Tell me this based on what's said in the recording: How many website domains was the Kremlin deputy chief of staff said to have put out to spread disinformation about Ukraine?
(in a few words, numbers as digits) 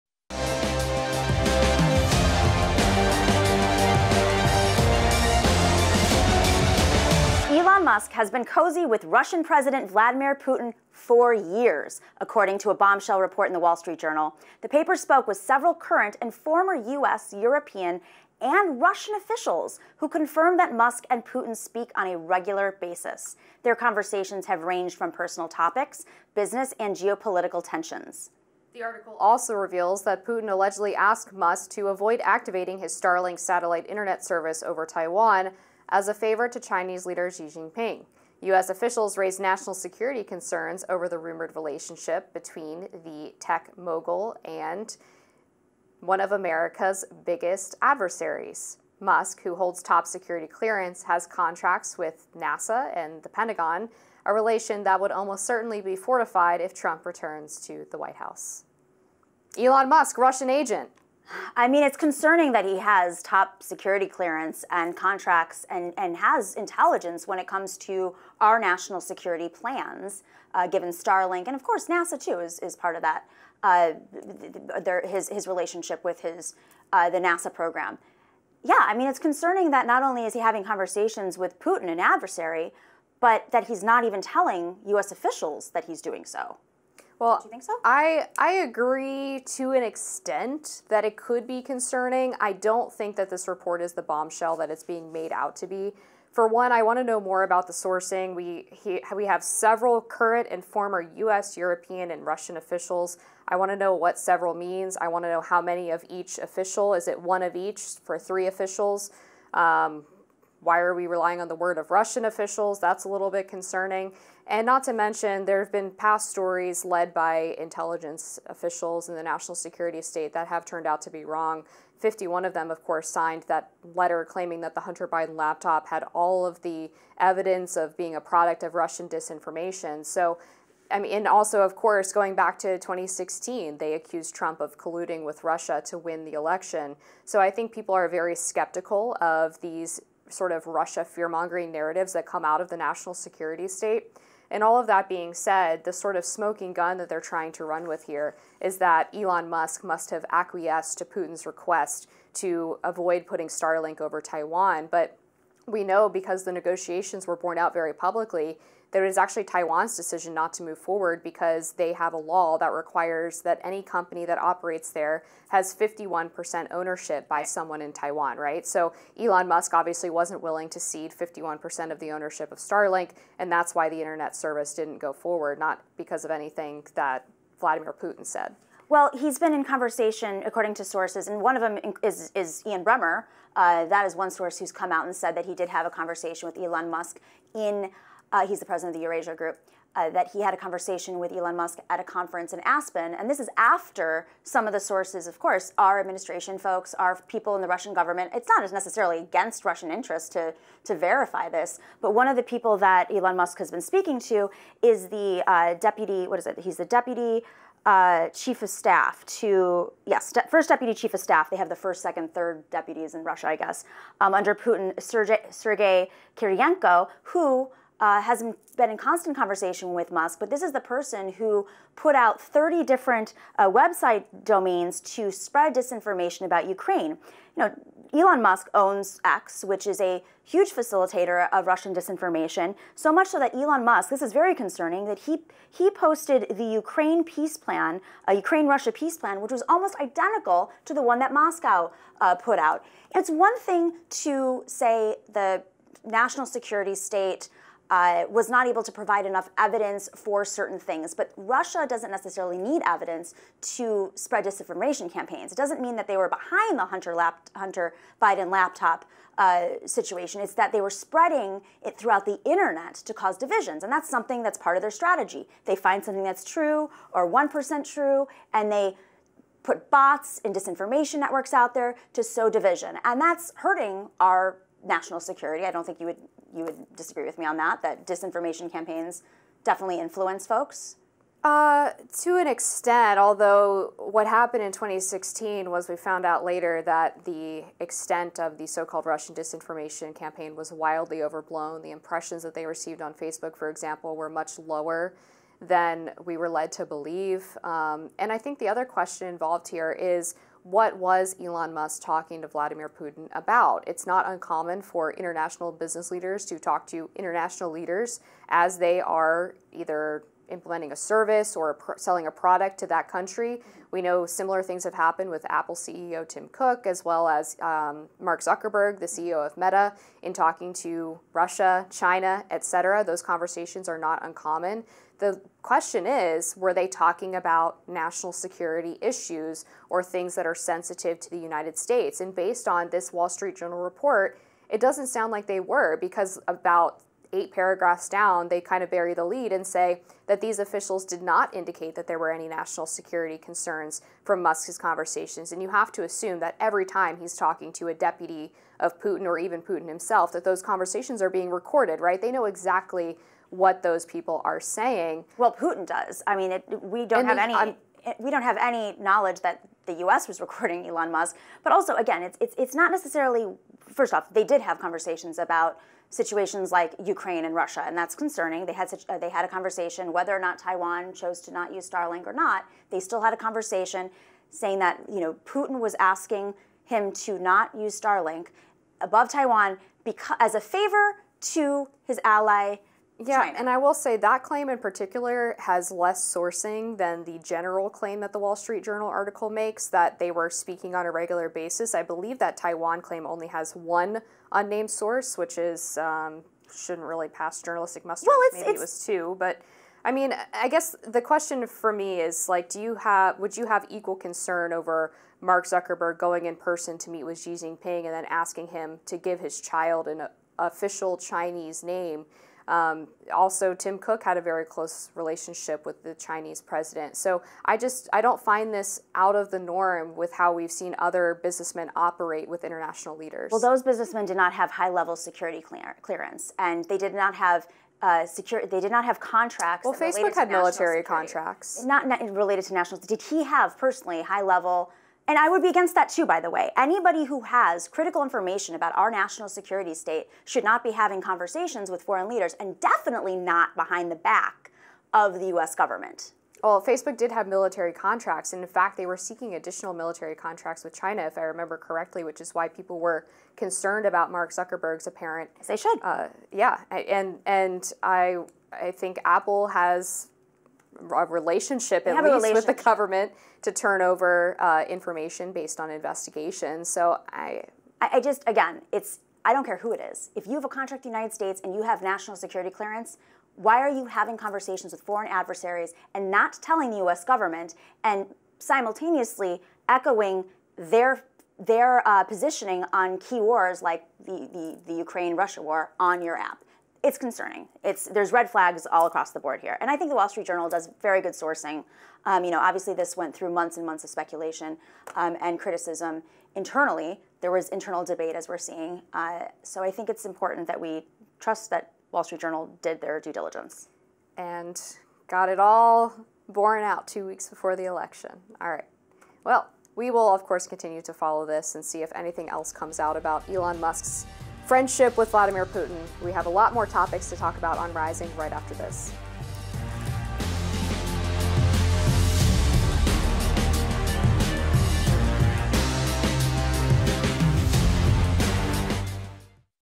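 30.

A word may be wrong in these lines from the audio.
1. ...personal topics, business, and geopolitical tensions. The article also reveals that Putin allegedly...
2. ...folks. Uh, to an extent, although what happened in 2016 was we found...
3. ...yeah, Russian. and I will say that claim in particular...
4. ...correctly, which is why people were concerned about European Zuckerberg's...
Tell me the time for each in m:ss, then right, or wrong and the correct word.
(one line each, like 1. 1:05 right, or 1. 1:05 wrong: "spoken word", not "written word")
1. 0:25 right
2. 4:40 right
3. 6:23 wrong: "China", not "Russian"
4. 7:31 wrong: "Mark", not "European".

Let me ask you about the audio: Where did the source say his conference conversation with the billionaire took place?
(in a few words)
Aspen.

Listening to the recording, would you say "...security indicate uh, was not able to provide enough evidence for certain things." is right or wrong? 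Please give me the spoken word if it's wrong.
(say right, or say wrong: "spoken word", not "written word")
wrong: "state", not "indicate".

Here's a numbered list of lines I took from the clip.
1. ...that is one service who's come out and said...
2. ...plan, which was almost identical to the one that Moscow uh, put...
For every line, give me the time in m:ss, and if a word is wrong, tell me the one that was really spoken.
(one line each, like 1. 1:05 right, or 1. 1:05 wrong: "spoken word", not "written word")
1. 3:03 wrong: "source", not "service"
2. 3:59 right.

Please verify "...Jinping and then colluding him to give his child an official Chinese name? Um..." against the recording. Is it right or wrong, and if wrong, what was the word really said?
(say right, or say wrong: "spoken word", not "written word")
wrong: "asking", not "colluding".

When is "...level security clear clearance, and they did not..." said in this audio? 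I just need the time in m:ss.
7:04.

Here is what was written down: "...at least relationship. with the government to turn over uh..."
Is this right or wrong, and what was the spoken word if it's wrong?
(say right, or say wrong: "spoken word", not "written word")
right.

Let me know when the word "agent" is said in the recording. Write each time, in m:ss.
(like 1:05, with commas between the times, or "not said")
1:00.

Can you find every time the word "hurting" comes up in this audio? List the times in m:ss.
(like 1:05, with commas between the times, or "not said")
4:33.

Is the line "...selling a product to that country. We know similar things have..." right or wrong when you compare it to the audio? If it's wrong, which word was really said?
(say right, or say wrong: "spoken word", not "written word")
right.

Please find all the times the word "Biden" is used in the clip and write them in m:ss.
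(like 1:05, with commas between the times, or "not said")
2:05, 4:18.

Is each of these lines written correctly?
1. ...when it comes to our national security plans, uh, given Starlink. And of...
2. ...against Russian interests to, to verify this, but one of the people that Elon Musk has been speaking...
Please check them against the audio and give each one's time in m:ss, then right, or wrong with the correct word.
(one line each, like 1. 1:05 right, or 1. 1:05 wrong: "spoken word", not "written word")
1. 1:07 right
2. 3:19 right.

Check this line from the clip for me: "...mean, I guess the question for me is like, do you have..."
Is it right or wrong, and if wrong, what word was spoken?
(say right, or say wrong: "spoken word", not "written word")
right.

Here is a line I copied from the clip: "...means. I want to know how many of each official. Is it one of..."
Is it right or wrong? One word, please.
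right.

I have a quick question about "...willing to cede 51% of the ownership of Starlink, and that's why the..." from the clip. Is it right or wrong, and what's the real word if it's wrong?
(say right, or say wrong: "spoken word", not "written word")
right.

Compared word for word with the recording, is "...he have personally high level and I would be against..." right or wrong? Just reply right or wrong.
right.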